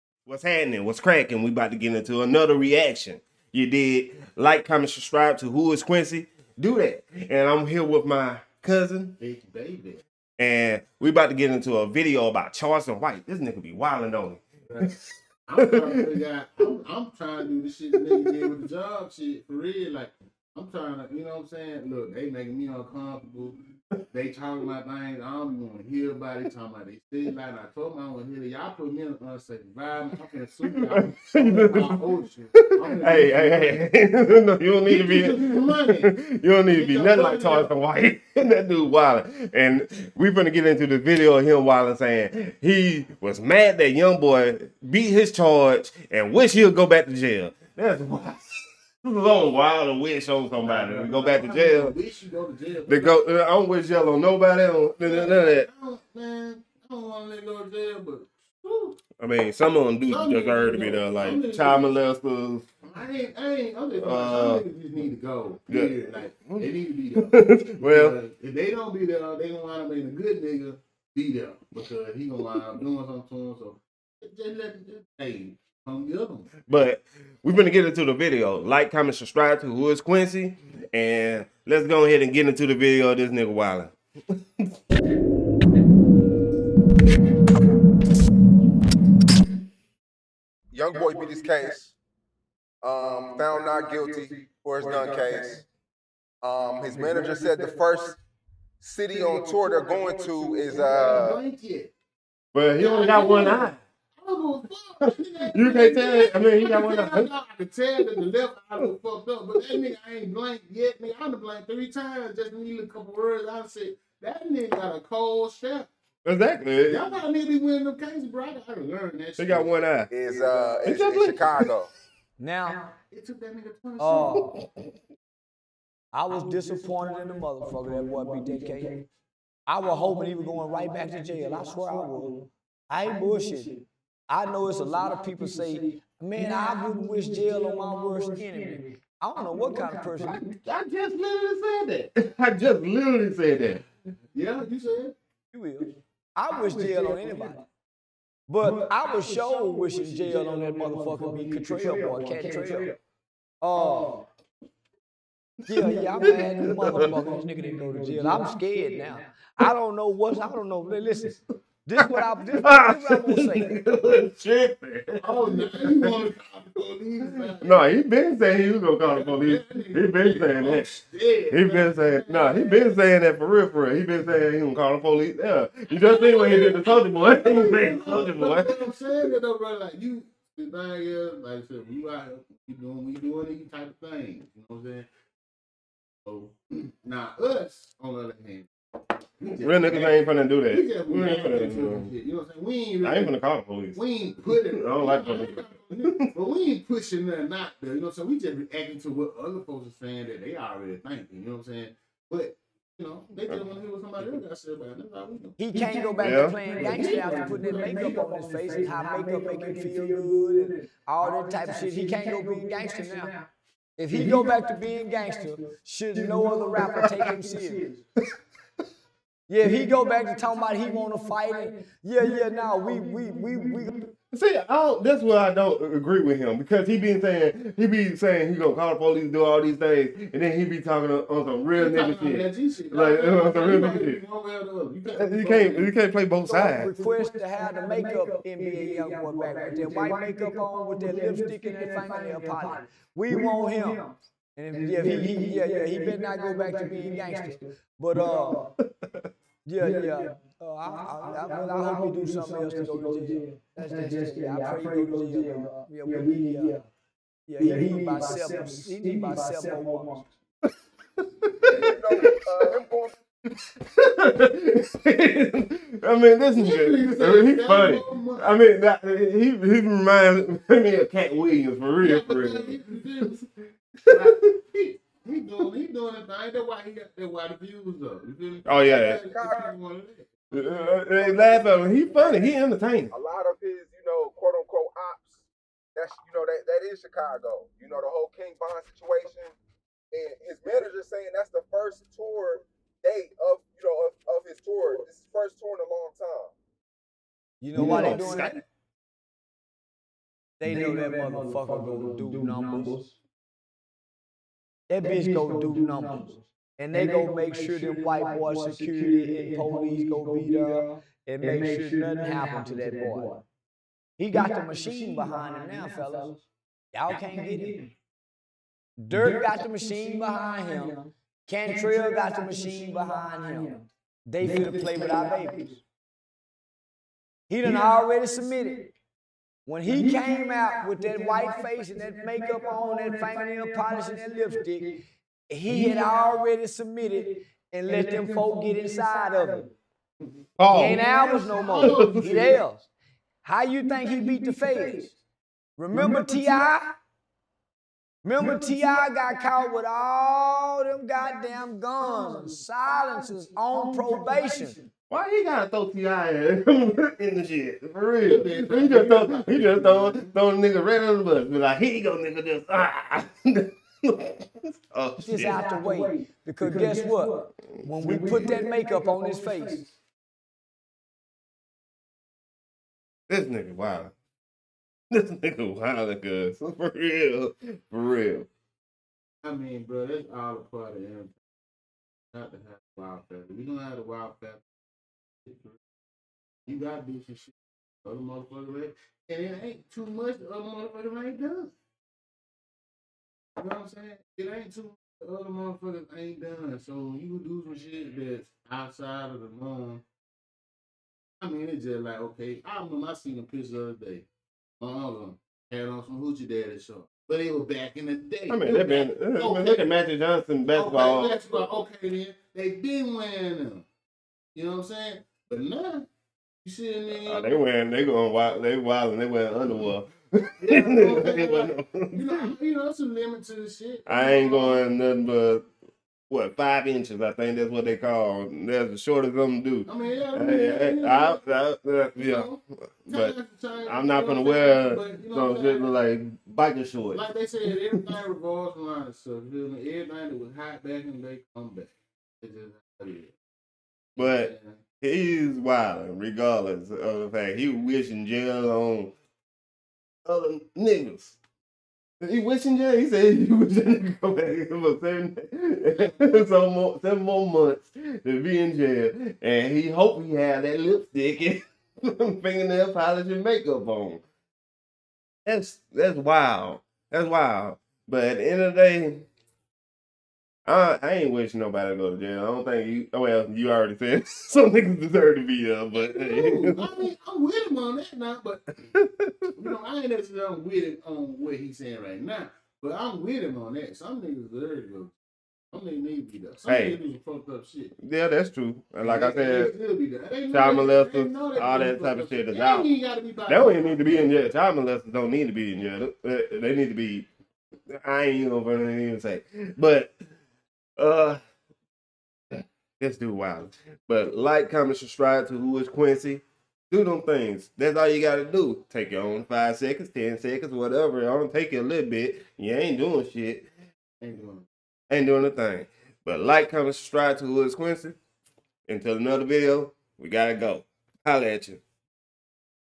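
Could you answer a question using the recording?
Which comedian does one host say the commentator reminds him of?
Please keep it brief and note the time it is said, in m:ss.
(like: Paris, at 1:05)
Katt Williams, at 4:31.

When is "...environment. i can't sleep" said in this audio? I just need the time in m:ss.
0:29.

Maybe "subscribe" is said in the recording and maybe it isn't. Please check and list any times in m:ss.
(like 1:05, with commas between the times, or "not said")
0:04, 1:19, 8:24, 8:36.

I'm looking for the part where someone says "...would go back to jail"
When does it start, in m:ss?
0:46.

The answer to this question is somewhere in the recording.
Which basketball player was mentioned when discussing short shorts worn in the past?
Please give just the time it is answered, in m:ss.
6:49.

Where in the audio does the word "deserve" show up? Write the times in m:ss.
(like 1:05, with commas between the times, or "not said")
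1:00, 7:54, 8:04.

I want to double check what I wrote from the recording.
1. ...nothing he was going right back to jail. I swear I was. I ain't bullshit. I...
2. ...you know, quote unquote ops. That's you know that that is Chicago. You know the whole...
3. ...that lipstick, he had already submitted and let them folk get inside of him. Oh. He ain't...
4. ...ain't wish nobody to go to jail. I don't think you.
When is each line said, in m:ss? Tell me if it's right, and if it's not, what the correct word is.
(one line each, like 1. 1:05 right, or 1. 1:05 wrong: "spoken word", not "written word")
1. 2:09 wrong: "hoping", not "nothing"
2. 4:43 right
3. 5:34 right
4. 7:51 right.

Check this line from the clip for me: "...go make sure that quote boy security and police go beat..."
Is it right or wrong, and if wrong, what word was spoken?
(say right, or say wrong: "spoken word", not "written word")
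wrong: "white", not "quote".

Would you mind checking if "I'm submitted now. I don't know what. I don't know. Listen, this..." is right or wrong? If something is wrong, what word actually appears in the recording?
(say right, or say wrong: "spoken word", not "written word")
wrong: "scared", not "submitted".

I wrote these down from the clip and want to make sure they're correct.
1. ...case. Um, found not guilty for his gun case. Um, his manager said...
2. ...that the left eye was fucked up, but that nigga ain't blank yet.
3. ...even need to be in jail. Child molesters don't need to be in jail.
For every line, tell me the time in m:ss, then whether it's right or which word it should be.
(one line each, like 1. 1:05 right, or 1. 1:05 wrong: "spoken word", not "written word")
1. 1:31 right
2. 1:48 right
3. 8:13 right.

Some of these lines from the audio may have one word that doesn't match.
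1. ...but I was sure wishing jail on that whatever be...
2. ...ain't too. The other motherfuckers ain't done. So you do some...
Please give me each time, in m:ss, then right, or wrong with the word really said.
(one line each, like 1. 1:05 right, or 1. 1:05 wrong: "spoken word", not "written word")
1. 2:28 wrong: "motherfucker", not "whatever"
2. 6:34 right.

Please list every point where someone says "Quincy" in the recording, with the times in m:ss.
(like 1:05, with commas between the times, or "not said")
0:05, 1:20, 8:25, 8:37.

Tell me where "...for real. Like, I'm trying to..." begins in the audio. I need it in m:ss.
0:19.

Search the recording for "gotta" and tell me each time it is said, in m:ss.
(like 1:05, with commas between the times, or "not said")
1:58, 5:55, 6:26, 8:28, 8:40.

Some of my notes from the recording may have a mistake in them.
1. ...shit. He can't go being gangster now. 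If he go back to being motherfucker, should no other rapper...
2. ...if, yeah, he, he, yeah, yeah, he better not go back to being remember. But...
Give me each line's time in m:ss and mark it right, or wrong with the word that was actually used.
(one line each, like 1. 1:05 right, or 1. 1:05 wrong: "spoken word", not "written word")
1. 3:31 wrong: "gangster", not "motherfucker"
2. 4:04 wrong: "gangster", not "remember".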